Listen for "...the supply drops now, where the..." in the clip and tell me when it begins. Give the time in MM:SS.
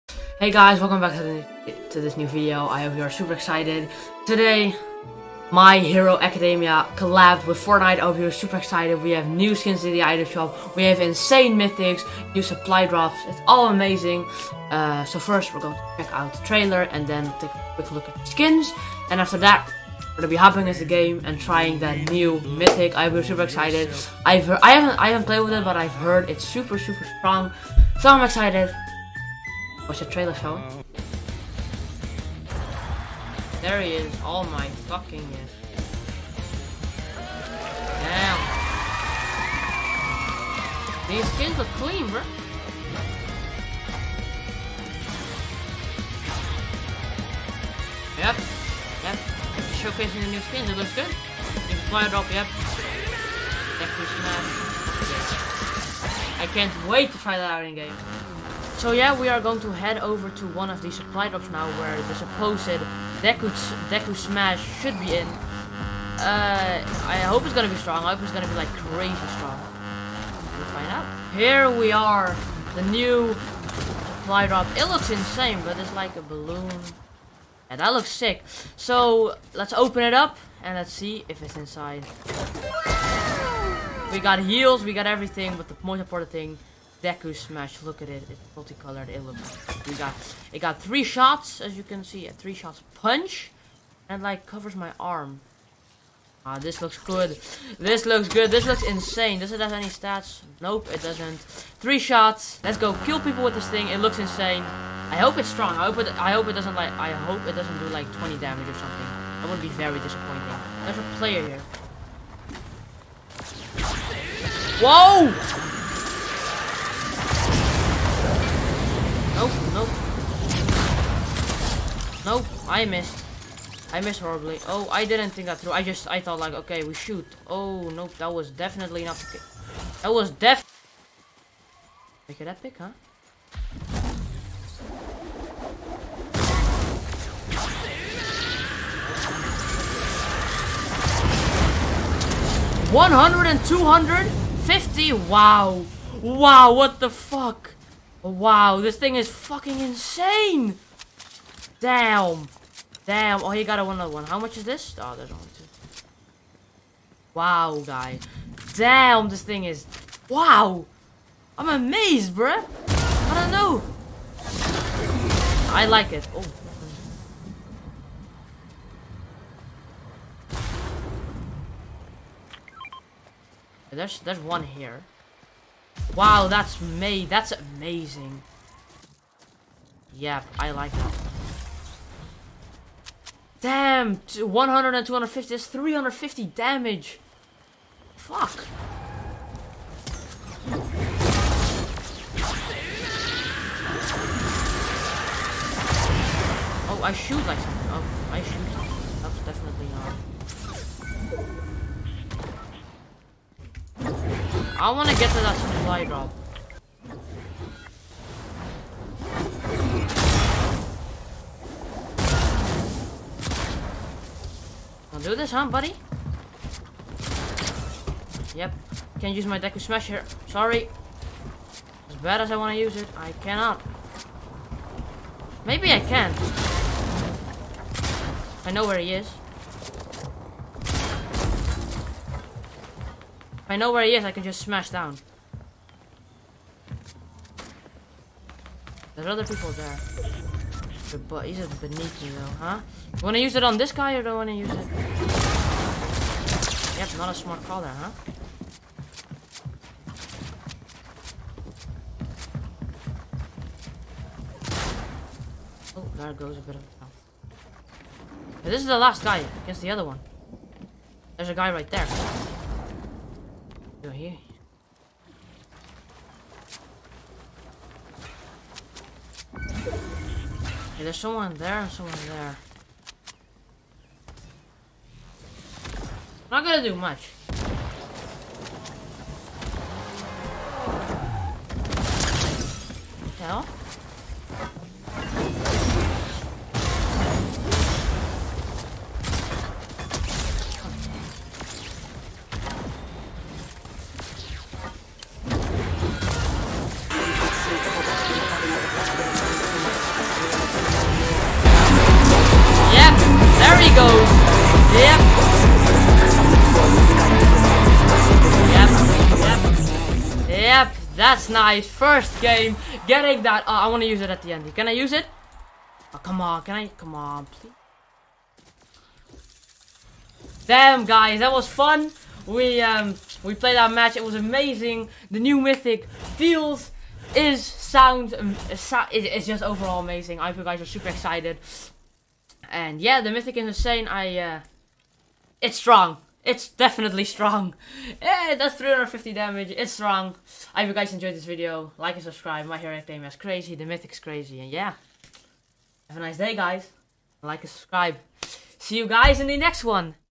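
01:00.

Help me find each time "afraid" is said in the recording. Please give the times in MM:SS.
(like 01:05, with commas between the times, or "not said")
not said.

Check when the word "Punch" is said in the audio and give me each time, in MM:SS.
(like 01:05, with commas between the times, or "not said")
01:32.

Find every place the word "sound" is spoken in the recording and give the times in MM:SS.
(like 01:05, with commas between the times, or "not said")
05:27.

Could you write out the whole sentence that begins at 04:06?
Yep, not a smart call there, huh?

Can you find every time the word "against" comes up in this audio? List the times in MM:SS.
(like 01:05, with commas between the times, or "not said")
04:19.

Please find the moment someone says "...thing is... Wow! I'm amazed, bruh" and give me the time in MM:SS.
02:39.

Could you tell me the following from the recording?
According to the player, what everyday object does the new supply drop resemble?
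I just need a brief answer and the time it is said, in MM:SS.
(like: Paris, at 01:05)
A balloon, at 01:16.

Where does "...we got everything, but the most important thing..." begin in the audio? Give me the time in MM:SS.
01:24.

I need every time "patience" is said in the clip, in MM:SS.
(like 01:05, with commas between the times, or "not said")
not said.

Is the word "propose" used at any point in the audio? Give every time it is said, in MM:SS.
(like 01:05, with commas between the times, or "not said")
not said.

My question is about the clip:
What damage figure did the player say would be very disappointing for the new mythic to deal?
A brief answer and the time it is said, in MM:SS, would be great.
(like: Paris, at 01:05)
20, at 01:48.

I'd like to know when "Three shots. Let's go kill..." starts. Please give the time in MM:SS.
01:41.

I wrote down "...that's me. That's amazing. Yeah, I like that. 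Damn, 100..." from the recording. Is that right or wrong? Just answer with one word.
right.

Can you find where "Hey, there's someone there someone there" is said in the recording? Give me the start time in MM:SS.
04:30.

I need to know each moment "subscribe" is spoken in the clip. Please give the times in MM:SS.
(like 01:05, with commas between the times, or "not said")
05:42, 05:47.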